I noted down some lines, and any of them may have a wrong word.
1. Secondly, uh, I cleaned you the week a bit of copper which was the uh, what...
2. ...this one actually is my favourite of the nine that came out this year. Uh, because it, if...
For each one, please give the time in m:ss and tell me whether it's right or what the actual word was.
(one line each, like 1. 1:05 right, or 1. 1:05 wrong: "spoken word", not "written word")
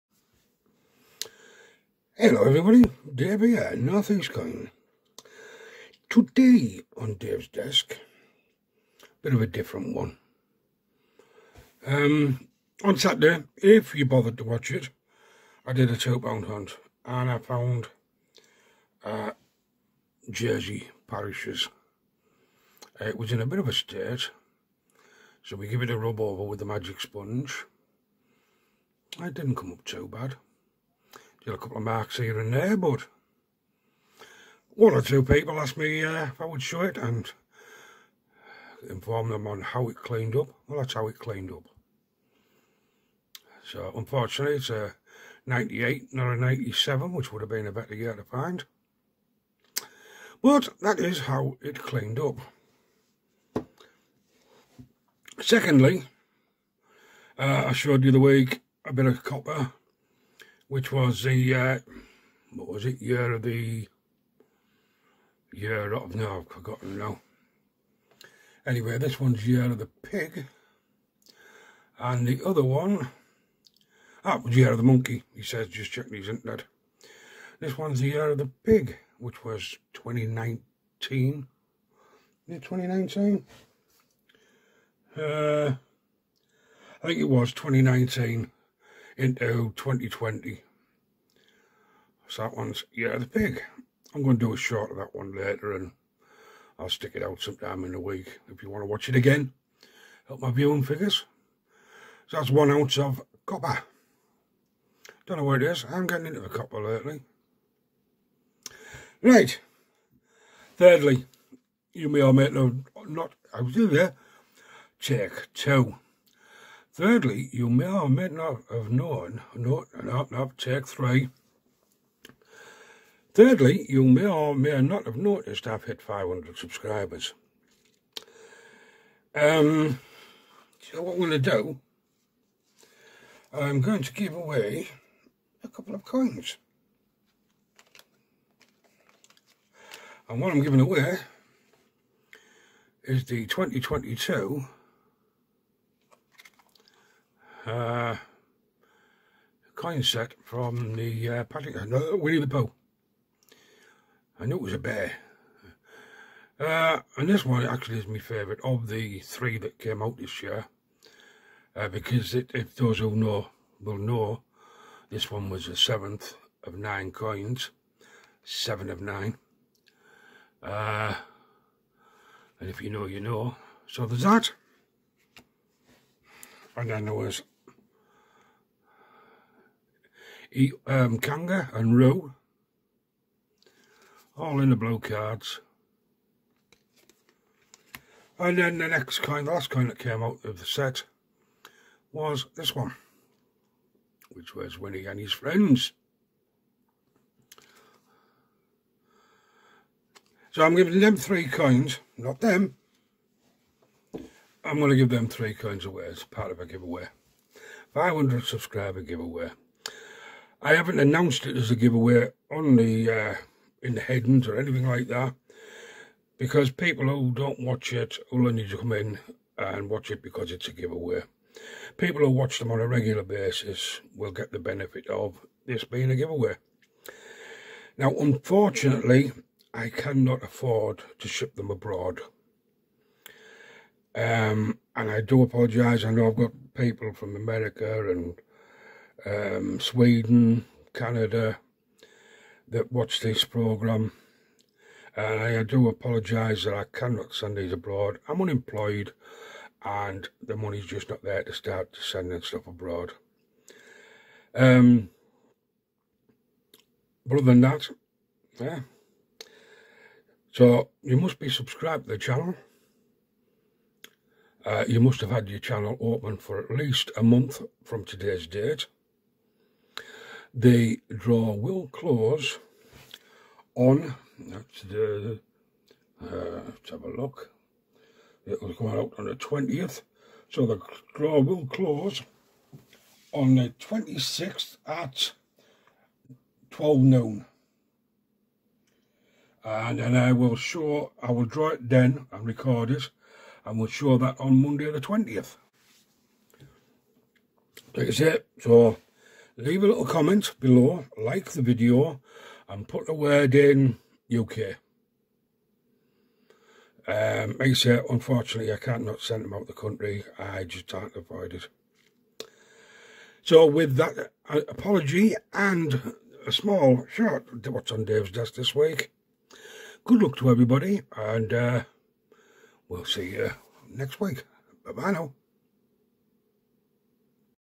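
1. 0:55 wrong: "showed", not "cleaned"
2. 2:37 wrong: "three", not "nine".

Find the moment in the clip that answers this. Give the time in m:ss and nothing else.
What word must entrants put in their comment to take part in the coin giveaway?
5:04.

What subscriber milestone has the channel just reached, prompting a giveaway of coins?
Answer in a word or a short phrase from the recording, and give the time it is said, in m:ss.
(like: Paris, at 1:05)
500, at 2:06.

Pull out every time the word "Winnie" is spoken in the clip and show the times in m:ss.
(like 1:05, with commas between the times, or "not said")
2:32, 3:14.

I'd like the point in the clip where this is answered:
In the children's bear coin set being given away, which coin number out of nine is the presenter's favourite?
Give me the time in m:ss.
2:45.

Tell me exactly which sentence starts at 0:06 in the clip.
Today on Dave's desk, bit of a different one.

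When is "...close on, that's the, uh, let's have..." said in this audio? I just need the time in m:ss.
4:31.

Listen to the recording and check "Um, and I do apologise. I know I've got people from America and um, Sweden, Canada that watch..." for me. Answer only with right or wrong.
right.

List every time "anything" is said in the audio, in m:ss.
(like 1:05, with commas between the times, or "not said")
3:34.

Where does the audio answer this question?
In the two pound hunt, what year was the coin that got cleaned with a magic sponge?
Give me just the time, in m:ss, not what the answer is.
0:45.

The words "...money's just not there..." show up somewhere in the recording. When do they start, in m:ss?
4:10.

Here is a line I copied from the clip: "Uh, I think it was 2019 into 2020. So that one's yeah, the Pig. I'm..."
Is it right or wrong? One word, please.
right.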